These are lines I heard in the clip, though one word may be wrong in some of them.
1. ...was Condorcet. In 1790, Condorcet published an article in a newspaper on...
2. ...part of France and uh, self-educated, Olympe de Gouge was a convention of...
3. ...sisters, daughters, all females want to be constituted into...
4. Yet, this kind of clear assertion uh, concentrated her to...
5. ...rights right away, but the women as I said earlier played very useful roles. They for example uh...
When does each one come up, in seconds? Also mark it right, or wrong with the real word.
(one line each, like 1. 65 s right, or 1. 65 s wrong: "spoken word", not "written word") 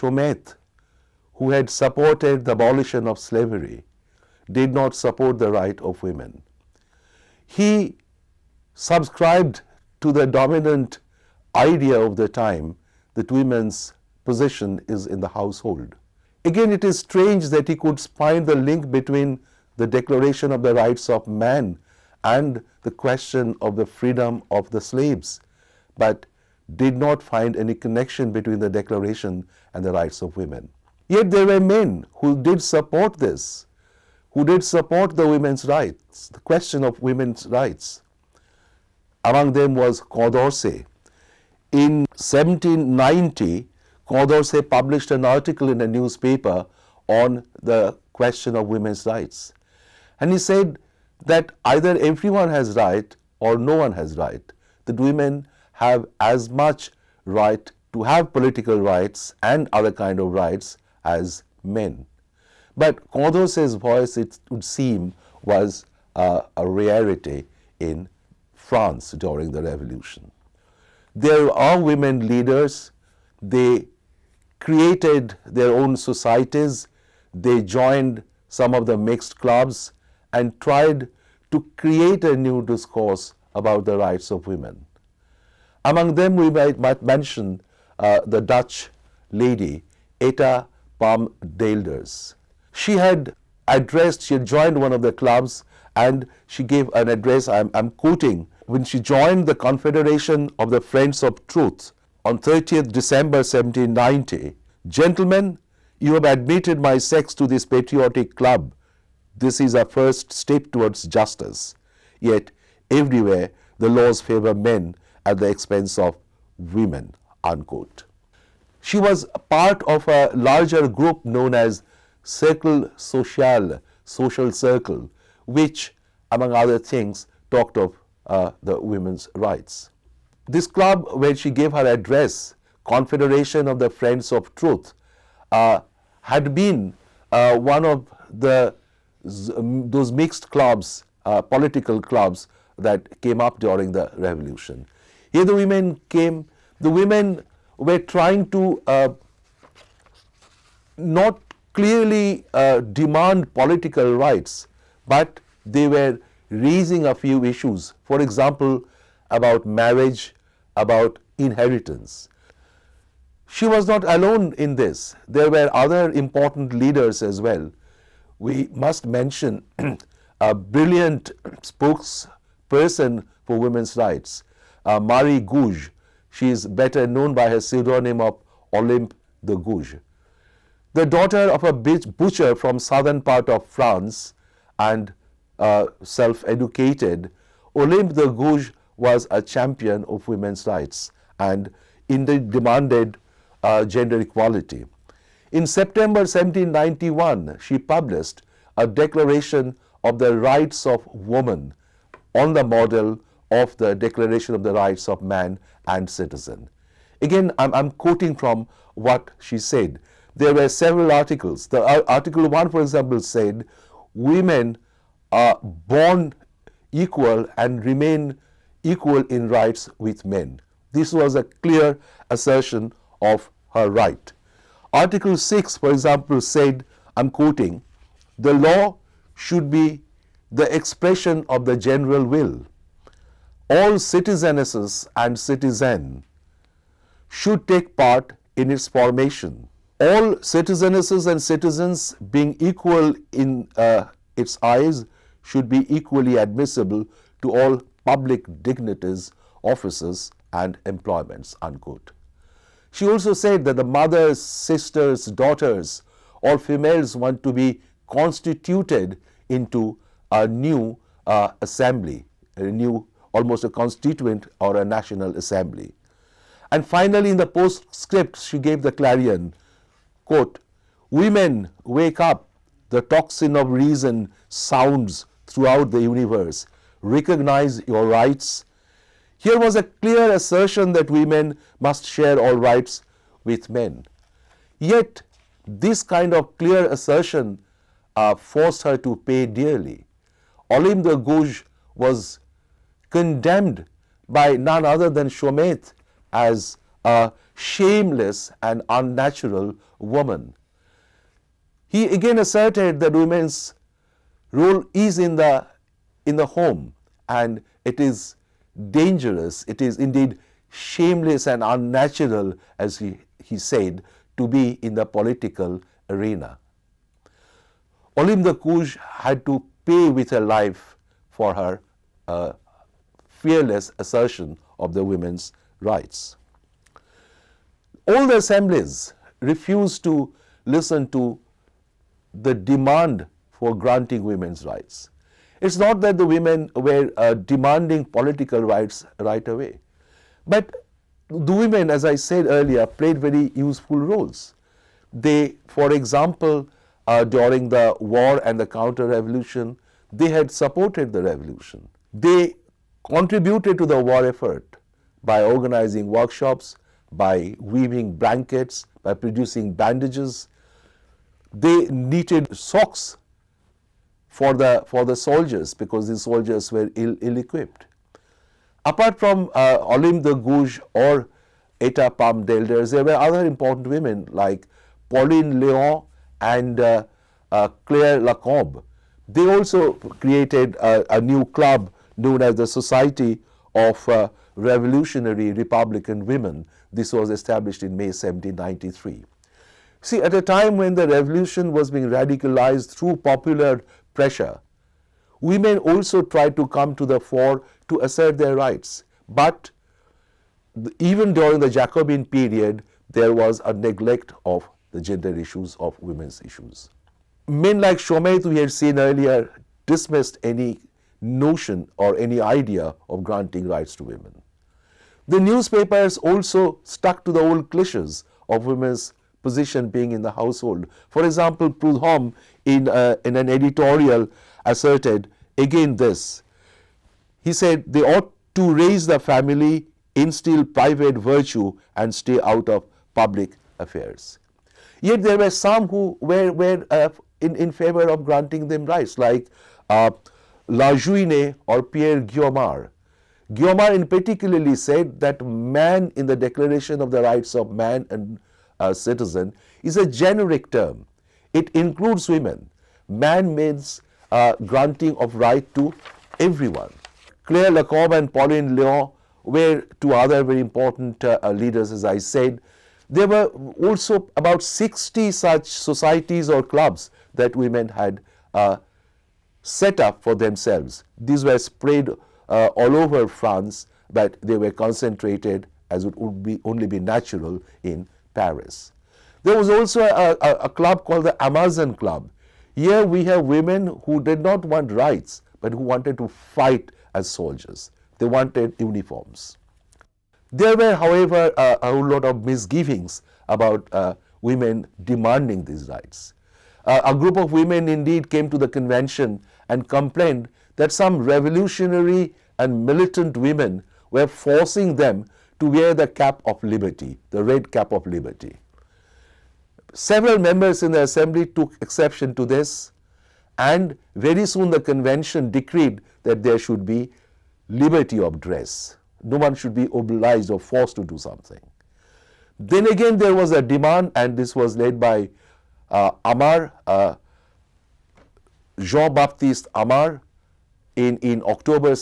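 1. 39 s right
2. 183 s wrong: "champion", not "convention"
3. 254 s right
4. 284 s wrong: "forced", not "concentrated"
5. 338 s right.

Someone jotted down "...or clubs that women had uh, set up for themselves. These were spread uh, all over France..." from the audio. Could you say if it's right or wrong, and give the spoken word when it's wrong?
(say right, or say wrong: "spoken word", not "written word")
right.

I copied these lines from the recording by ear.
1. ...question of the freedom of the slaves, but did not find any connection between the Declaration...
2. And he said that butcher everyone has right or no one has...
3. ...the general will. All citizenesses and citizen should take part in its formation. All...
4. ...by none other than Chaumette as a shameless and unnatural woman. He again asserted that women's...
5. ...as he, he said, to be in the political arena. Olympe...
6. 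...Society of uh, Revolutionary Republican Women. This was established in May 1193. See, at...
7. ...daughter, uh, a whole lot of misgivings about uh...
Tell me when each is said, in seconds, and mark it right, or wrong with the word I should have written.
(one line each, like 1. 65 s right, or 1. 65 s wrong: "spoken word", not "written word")
1. 22 s right
2. 50 s wrong: "either", not "butcher"
3. 231 s right
4. 294 s right
5. 312 s right
6. 382 s wrong: "1793", not "1193"
7. 490 s wrong: "however", not "daughter".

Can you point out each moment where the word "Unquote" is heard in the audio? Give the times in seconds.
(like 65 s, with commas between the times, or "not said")
117 s, 251 s.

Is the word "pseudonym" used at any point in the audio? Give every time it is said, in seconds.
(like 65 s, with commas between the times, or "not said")
177 s.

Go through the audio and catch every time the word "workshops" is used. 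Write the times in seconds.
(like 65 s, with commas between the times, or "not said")
356 s.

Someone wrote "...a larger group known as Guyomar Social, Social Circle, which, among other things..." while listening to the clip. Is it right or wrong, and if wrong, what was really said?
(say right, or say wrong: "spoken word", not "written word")
wrong: "Cercle", not "Guyomar".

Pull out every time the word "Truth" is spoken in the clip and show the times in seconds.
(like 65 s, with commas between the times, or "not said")
101 s, 134 s.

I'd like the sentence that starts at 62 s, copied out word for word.
But Condorcet's voice, it would seem, was uh, a rarity in France during the revolution.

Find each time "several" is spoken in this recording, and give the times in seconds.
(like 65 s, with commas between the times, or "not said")
210 s, 509 s.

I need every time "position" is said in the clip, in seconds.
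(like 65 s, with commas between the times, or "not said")
419 s.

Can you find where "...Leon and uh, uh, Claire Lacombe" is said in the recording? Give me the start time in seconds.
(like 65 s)
375 s.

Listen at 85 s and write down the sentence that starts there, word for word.
Among them, we might, might mention uh, the Dutch lady, Etta Palm d'Aelders.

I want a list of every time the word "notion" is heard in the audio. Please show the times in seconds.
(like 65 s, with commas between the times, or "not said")
411 s.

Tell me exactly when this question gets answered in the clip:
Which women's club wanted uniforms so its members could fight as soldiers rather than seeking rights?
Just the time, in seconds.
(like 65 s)
481 s.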